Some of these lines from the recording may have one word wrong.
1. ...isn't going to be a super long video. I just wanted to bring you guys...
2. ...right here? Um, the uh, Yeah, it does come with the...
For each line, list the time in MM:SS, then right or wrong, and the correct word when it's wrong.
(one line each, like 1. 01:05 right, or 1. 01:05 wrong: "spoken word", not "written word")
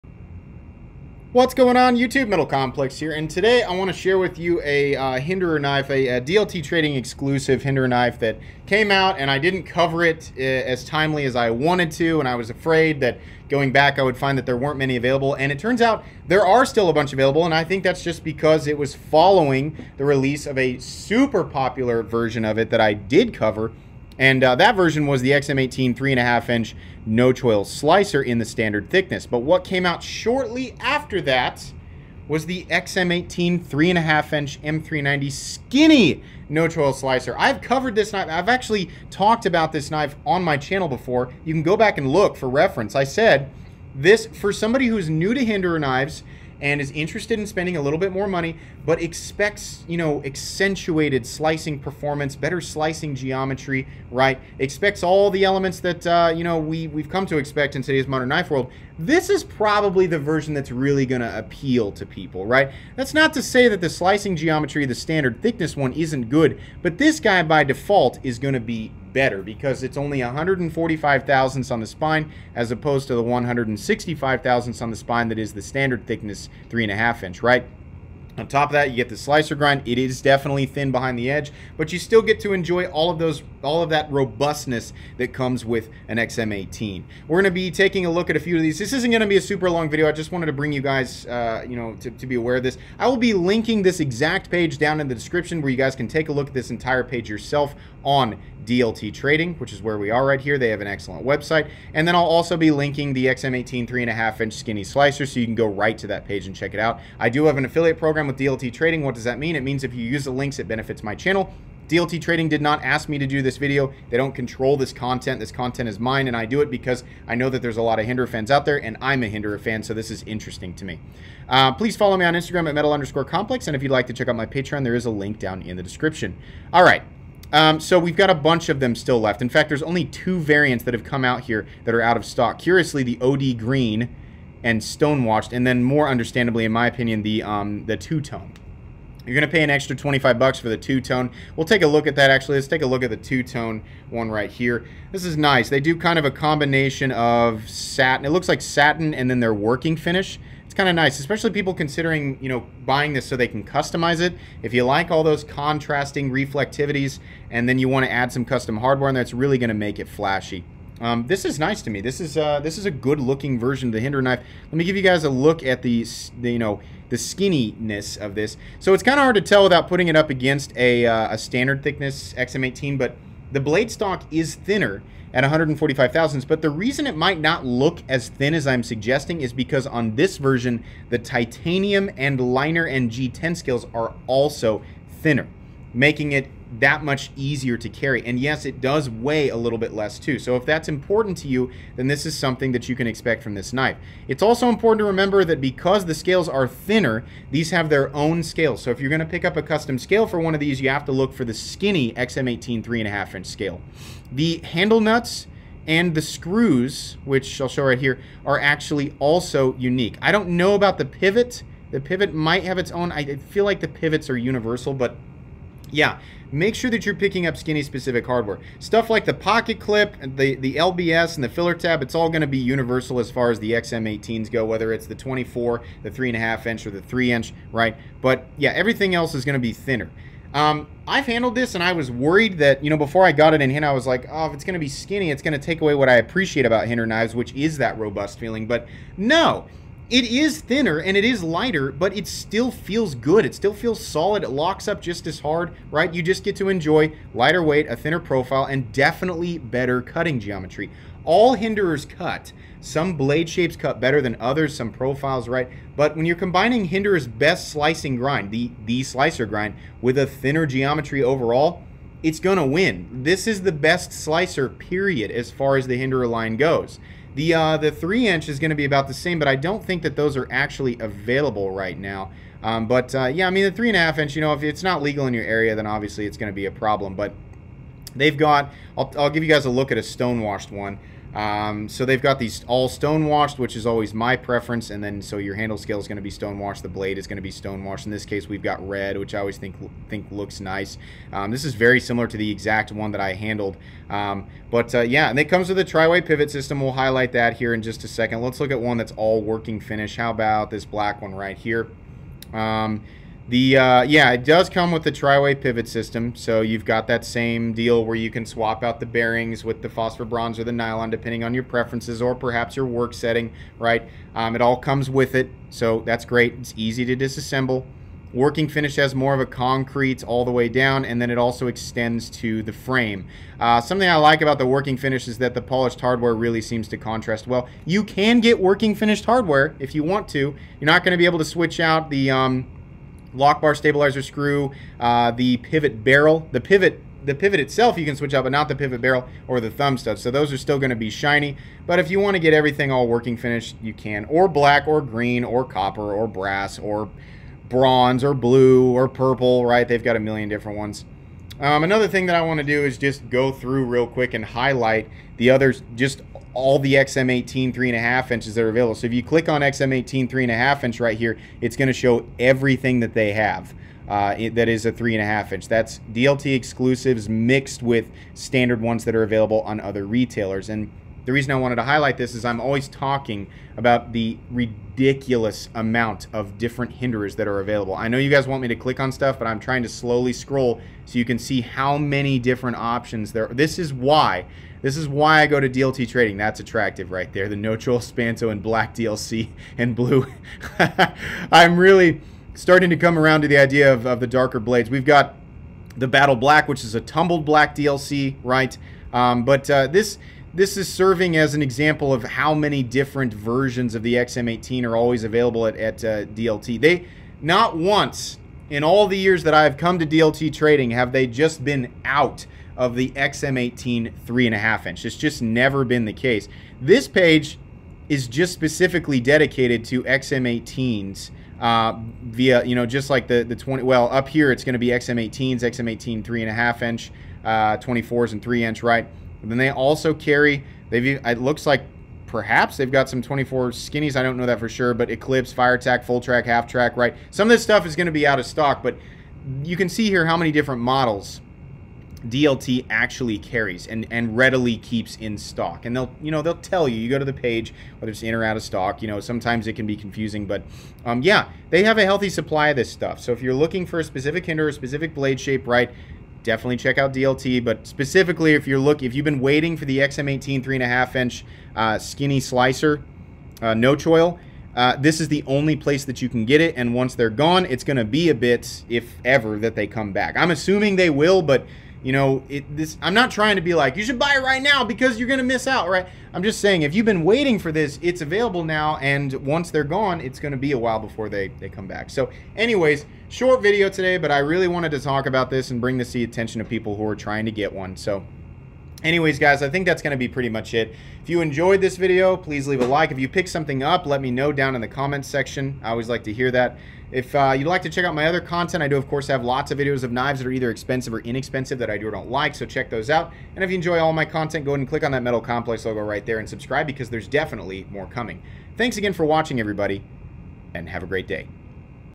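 1. 01:28 right
2. 05:01 right.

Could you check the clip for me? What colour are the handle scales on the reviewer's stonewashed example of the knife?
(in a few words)
red.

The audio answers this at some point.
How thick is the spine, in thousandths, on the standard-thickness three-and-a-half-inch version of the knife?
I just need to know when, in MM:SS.
01:13.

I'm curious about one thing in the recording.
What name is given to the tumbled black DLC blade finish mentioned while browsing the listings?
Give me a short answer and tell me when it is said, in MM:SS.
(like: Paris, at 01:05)
Battle Black, at 06:36.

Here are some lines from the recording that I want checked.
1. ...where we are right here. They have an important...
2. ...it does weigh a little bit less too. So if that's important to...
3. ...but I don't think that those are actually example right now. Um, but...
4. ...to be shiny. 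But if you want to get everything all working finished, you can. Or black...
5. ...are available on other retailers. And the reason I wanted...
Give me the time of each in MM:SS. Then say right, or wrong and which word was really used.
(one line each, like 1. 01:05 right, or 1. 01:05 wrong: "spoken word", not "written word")
1. 01:39 wrong: "excellent", not "important"
2. 03:08 right
3. 04:29 wrong: "available", not "example"
4. 05:40 right
5. 06:09 right.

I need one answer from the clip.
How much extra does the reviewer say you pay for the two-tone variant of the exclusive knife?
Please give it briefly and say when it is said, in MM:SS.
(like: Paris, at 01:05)
25 dollars, at 02:19.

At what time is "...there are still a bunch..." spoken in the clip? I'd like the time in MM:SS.
00:16.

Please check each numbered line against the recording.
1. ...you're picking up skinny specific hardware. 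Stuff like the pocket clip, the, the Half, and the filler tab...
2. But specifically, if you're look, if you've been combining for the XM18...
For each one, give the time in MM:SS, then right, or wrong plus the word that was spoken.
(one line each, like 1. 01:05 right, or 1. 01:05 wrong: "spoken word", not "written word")
1. 03:37 wrong: "LBS", not "Half"
2. 07:37 wrong: "waiting", not "combining".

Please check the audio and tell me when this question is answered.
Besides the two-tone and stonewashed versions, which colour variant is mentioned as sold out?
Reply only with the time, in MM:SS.
02:13.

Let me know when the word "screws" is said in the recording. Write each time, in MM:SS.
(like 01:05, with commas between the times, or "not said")
03:26, 05:34.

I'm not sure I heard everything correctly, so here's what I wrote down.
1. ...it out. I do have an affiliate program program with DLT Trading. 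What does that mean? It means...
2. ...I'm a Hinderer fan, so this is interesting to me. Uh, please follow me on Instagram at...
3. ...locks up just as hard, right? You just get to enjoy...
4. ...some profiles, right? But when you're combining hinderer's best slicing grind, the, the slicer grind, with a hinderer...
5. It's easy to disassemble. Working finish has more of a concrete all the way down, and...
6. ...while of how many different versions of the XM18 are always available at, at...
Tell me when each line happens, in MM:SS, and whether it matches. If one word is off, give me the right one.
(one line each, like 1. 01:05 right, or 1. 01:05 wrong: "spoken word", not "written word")
1. 01:46 right
2. 01:59 right
3. 04:04 right
4. 04:14 wrong: "thinner", not "hinderer"
5. 05:16 right
6. 06:41 wrong: "example", not "while".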